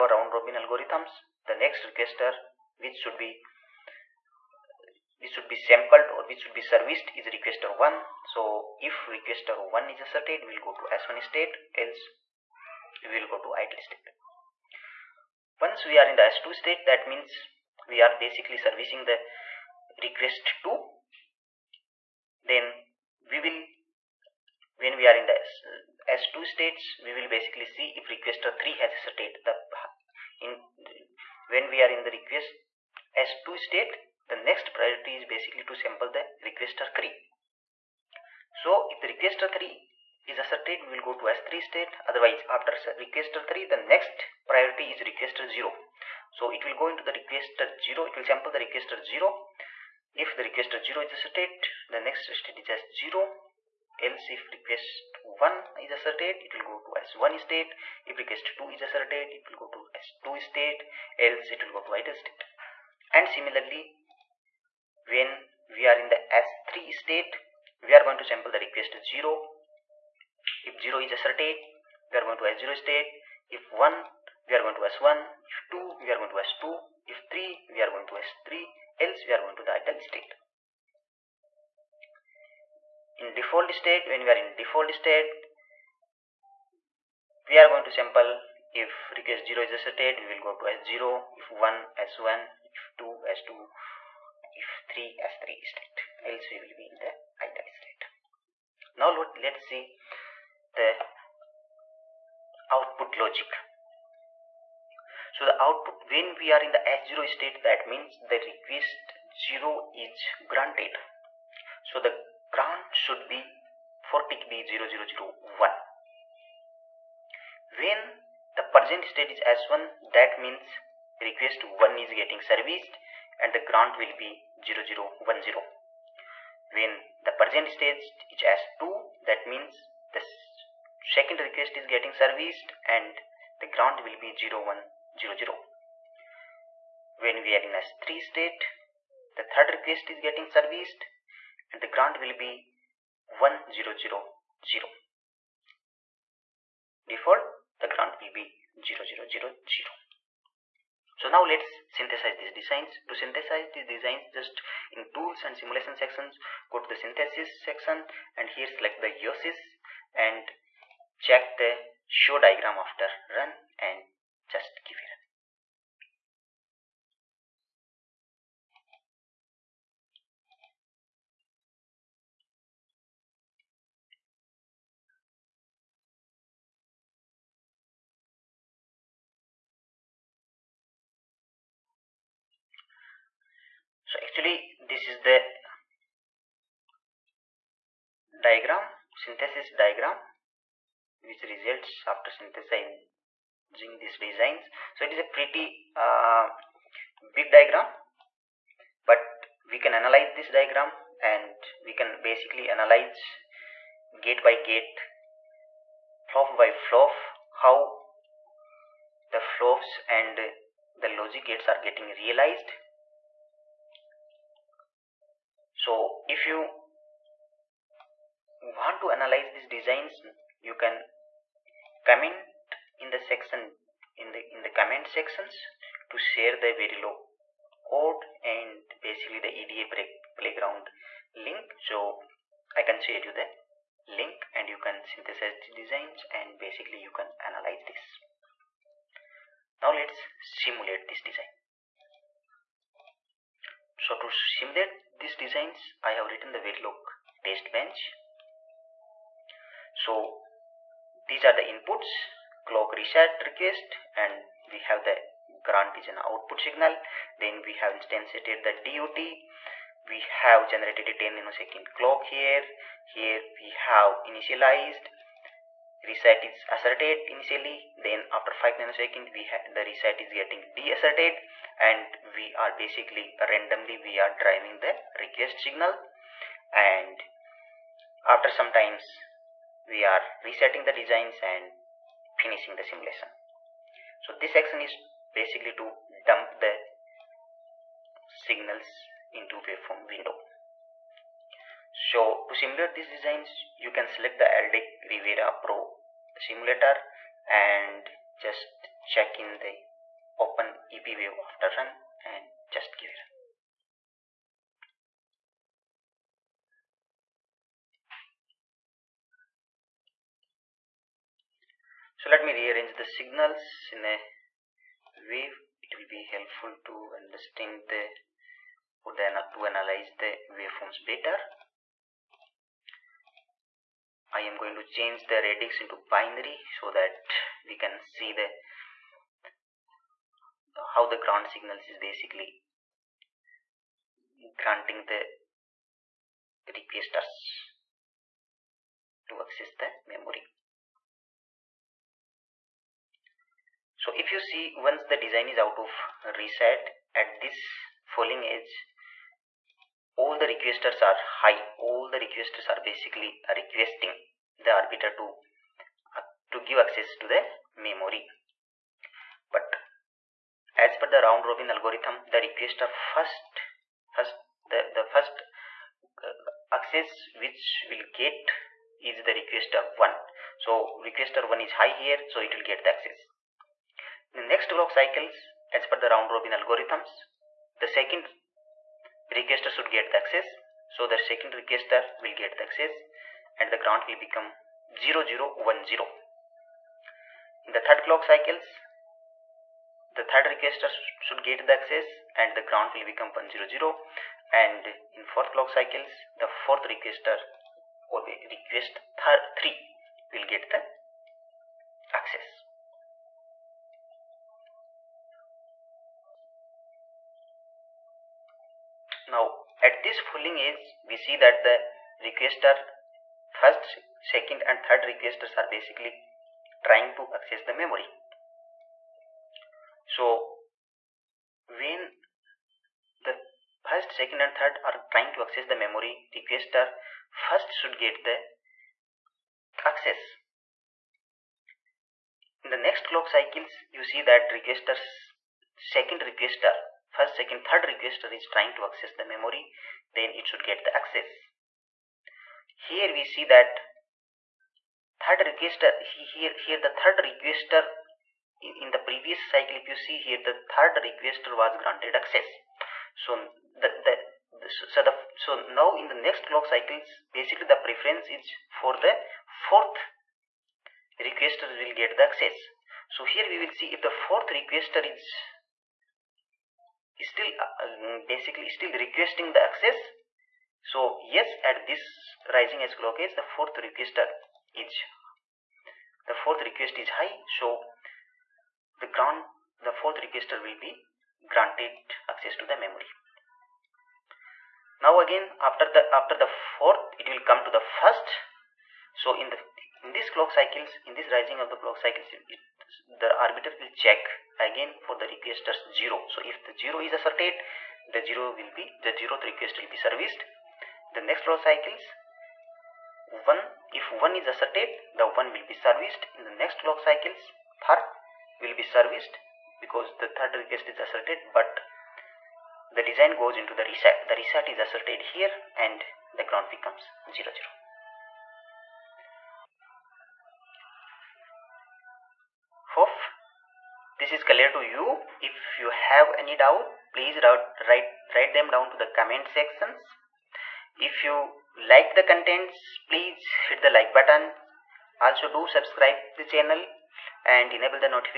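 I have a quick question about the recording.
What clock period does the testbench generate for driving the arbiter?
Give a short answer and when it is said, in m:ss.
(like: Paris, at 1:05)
10 nanoseconds, at 4:21.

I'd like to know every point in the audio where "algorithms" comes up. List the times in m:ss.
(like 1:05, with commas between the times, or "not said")
0:00, 6:01, 6:16.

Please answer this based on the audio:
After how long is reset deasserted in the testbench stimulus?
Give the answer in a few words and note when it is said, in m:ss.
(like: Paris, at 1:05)
5 nanoseconds, at 4:28.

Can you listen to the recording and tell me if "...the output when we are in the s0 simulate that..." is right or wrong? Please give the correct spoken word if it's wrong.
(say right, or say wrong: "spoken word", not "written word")
wrong: "state", not "simulate".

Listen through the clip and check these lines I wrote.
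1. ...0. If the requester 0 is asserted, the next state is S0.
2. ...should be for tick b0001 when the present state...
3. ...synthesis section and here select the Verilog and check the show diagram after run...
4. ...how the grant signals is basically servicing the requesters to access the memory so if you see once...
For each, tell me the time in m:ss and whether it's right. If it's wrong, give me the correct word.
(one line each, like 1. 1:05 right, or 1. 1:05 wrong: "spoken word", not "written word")
1. 0:49 right
2. 1:53 right
3. 2:37 wrong: "Yosys", not "Verilog"
4. 5:30 wrong: "granting", not "servicing".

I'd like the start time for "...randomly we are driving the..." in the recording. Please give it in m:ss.
4:33.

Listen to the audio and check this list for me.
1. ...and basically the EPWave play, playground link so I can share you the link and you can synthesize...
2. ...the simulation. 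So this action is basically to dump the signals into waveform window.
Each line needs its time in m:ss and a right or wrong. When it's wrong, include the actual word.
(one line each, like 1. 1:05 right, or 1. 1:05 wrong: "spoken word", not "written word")
1. 3:48 wrong: "EDA", not "EPWave"
2. 4:42 right.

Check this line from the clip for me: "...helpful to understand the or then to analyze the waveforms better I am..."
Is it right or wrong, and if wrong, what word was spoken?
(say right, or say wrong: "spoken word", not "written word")
right.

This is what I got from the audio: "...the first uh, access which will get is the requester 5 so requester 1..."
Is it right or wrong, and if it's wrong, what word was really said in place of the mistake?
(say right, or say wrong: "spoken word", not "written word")
wrong: "1", not "5".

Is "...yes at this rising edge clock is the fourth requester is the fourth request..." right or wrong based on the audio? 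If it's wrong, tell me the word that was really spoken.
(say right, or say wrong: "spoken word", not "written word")
right.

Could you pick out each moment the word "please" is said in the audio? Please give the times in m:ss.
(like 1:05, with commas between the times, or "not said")
8:47, 8:53.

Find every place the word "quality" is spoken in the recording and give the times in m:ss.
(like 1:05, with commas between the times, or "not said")
not said.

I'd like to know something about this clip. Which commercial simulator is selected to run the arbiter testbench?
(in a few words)
Aldec Riviera Pro.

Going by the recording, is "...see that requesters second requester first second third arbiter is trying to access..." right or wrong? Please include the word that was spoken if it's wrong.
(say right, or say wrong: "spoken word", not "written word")
wrong: "requester", not "arbiter".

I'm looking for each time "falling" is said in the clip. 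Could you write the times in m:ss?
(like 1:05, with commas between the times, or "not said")
5:48, 6:50.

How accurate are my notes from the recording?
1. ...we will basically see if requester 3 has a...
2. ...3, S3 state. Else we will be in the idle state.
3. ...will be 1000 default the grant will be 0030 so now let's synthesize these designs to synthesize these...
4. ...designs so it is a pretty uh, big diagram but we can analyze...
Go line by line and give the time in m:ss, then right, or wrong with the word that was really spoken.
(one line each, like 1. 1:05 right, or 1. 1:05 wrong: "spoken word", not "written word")
1. 0:27 right
2. 1:34 right
3. 2:22 wrong: "0000", not "0030"
4. 3:14 right.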